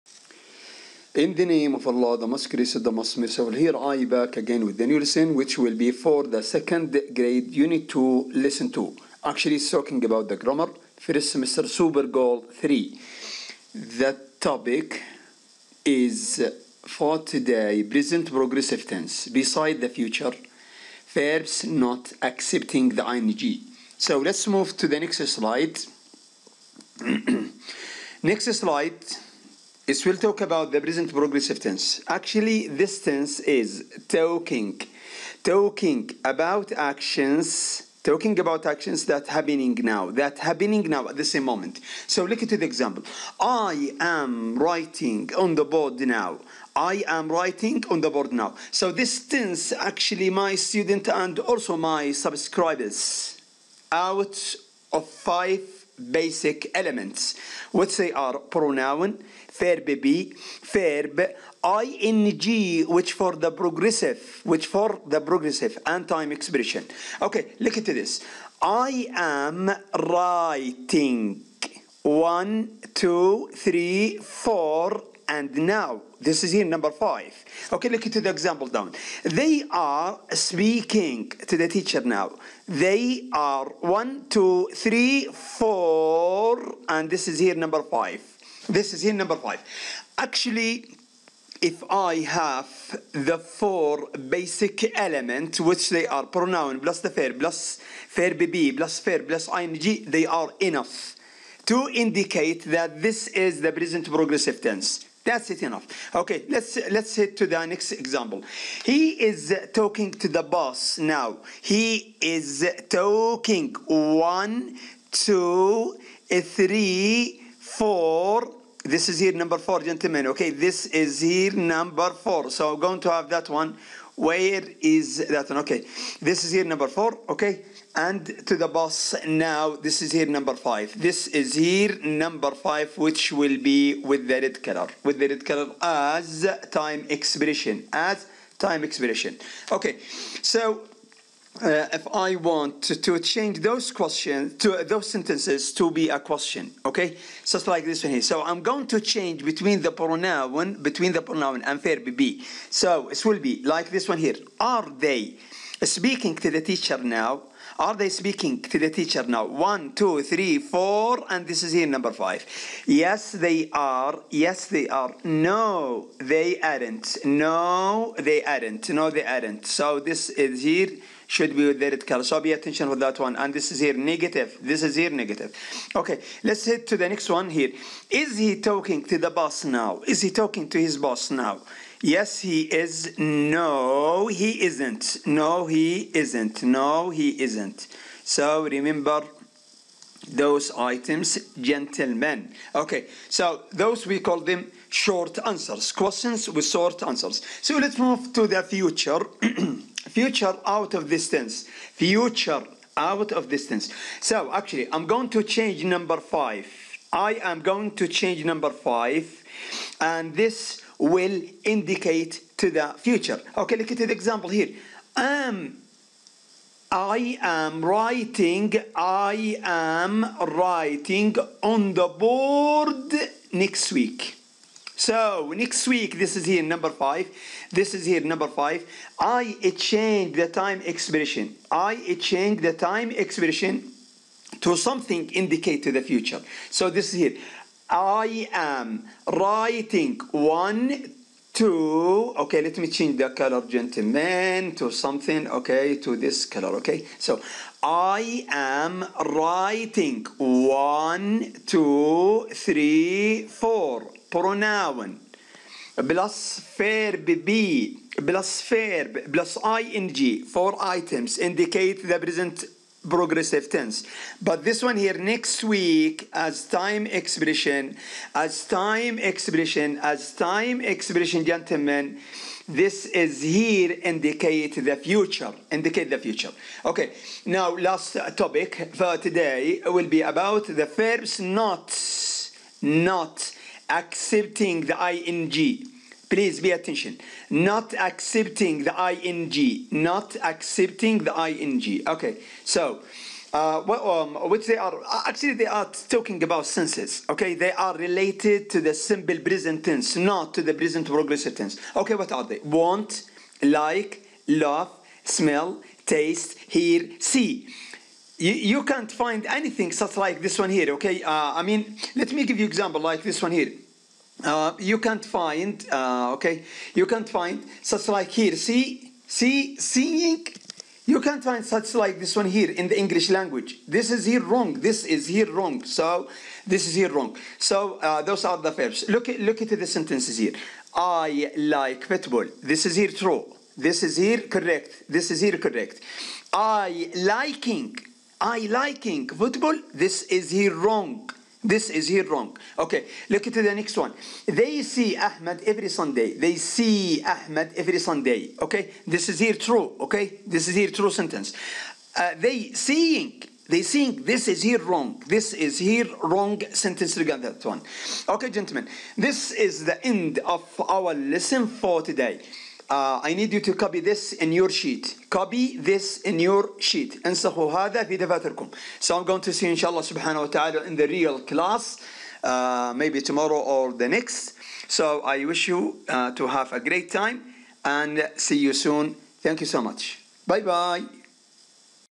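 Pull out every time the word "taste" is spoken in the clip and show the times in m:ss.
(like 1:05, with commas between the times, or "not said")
5:06.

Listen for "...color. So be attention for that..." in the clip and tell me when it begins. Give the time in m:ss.
2:51.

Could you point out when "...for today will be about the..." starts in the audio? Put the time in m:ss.
4:38.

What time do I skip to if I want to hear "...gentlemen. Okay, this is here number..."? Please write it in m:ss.
1:59.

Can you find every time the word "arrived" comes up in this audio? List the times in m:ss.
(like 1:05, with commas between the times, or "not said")
not said.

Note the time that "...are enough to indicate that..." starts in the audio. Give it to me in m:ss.
1:40.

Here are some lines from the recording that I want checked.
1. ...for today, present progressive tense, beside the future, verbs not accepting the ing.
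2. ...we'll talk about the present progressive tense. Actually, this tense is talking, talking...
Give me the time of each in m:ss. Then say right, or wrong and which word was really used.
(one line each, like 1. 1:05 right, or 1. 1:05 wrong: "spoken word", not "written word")
1. 0:16 right
2. 0:30 right.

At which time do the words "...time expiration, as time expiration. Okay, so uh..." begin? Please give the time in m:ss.
2:16.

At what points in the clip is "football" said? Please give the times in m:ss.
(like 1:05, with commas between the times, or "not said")
5:32, 5:39.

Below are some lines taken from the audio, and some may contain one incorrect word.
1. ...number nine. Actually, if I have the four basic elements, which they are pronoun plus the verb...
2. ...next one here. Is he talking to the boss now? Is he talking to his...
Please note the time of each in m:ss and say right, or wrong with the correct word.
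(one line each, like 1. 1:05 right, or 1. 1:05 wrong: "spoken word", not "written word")
1. 1:29 wrong: "five", not "nine"
2. 2:57 right.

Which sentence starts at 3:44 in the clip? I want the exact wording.
So next week, this is here number five.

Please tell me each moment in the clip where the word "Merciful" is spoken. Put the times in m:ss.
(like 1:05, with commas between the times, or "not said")
0:03.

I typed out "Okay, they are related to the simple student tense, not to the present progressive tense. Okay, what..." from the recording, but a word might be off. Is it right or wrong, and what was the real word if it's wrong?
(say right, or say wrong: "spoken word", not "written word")
wrong: "present", not "student".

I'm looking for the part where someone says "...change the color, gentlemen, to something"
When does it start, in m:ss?
4:02.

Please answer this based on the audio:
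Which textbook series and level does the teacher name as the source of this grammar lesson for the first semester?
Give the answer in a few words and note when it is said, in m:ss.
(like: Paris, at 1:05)
Super Goal 3, at 0:11.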